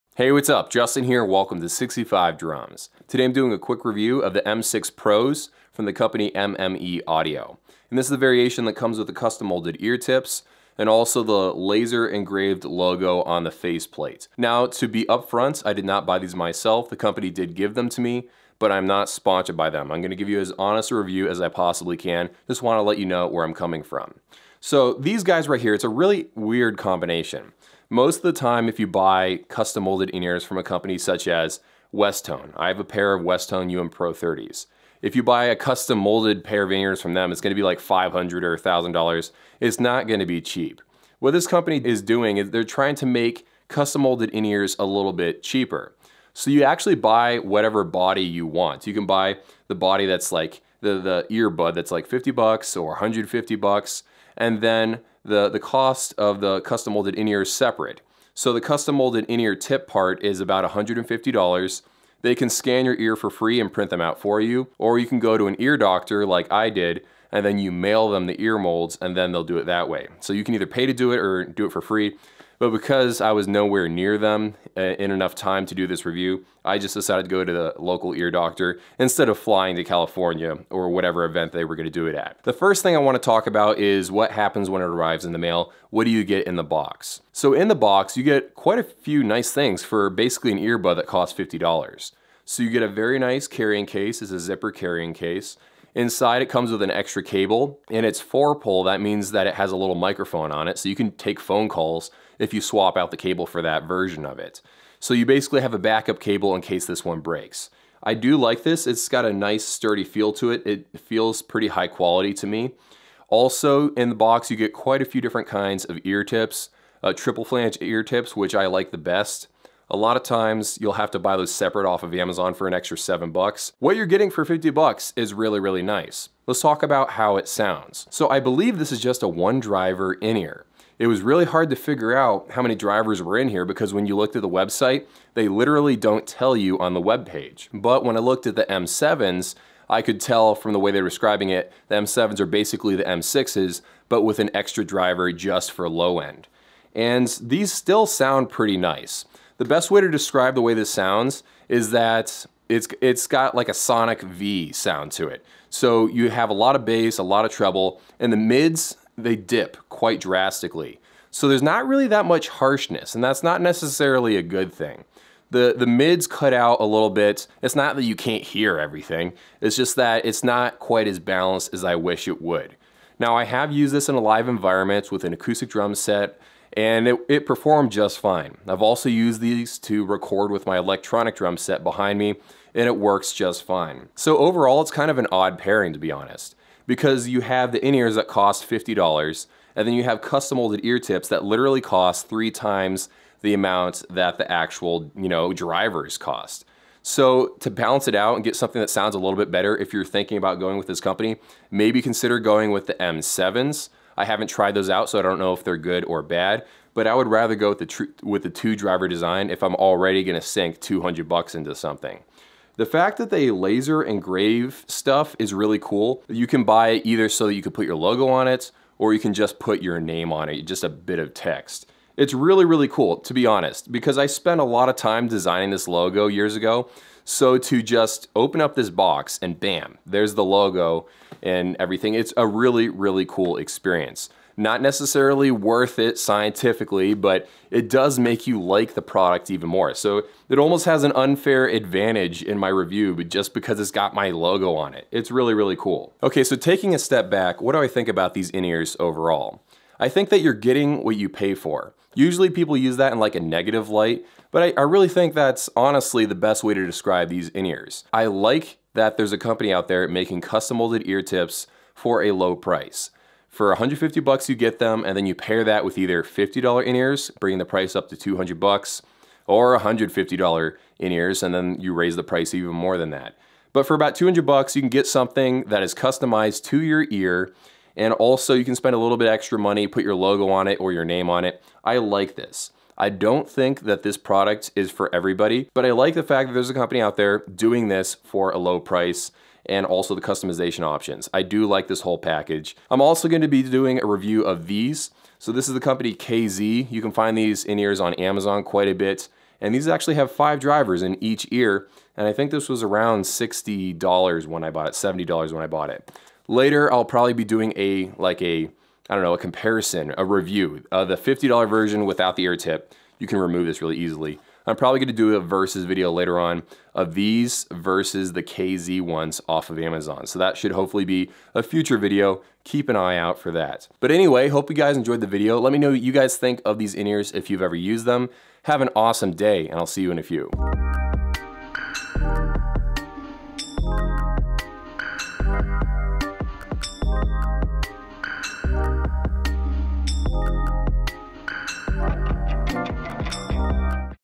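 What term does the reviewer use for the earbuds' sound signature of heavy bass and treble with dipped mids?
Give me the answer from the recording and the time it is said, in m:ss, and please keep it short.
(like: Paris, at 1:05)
sonic V, at 2:33.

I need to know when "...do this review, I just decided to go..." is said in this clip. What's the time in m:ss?
1:15.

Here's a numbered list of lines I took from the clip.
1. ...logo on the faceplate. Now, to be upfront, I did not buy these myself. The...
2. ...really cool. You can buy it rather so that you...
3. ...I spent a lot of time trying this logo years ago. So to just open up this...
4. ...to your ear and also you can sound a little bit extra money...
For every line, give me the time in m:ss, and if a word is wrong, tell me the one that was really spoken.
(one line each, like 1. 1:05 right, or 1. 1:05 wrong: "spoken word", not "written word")
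1. 0:12 right
2. 3:35 wrong: "either", not "rather"
3. 3:44 wrong: "designing", not "trying"
4. 4:36 wrong: "spend", not "sound".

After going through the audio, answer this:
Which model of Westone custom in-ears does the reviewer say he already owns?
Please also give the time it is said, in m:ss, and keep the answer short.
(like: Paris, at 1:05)
UM Pro 30, at 0:33.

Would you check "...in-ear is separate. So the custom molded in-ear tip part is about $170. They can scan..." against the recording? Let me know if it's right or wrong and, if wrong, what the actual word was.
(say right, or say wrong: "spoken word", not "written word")
wrong: "150", not "170".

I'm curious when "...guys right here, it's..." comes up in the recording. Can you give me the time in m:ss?
0:25.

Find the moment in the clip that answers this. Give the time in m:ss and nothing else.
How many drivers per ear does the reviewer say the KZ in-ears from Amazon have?
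5:00.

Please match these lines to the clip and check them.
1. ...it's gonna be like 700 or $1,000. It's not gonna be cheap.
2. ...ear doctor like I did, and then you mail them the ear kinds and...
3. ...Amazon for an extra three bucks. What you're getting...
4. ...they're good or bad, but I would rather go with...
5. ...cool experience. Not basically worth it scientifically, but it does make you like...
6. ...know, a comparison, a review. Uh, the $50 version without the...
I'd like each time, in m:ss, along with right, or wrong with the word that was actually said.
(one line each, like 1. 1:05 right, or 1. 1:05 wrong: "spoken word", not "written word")
1. 0:37 wrong: "500", not "700"
2. 1:05 wrong: "molds", not "kinds"
3. 2:02 wrong: "seven", not "three"
4. 3:25 right
5. 3:53 wrong: "necessarily", not "basically"
6. 5:09 right.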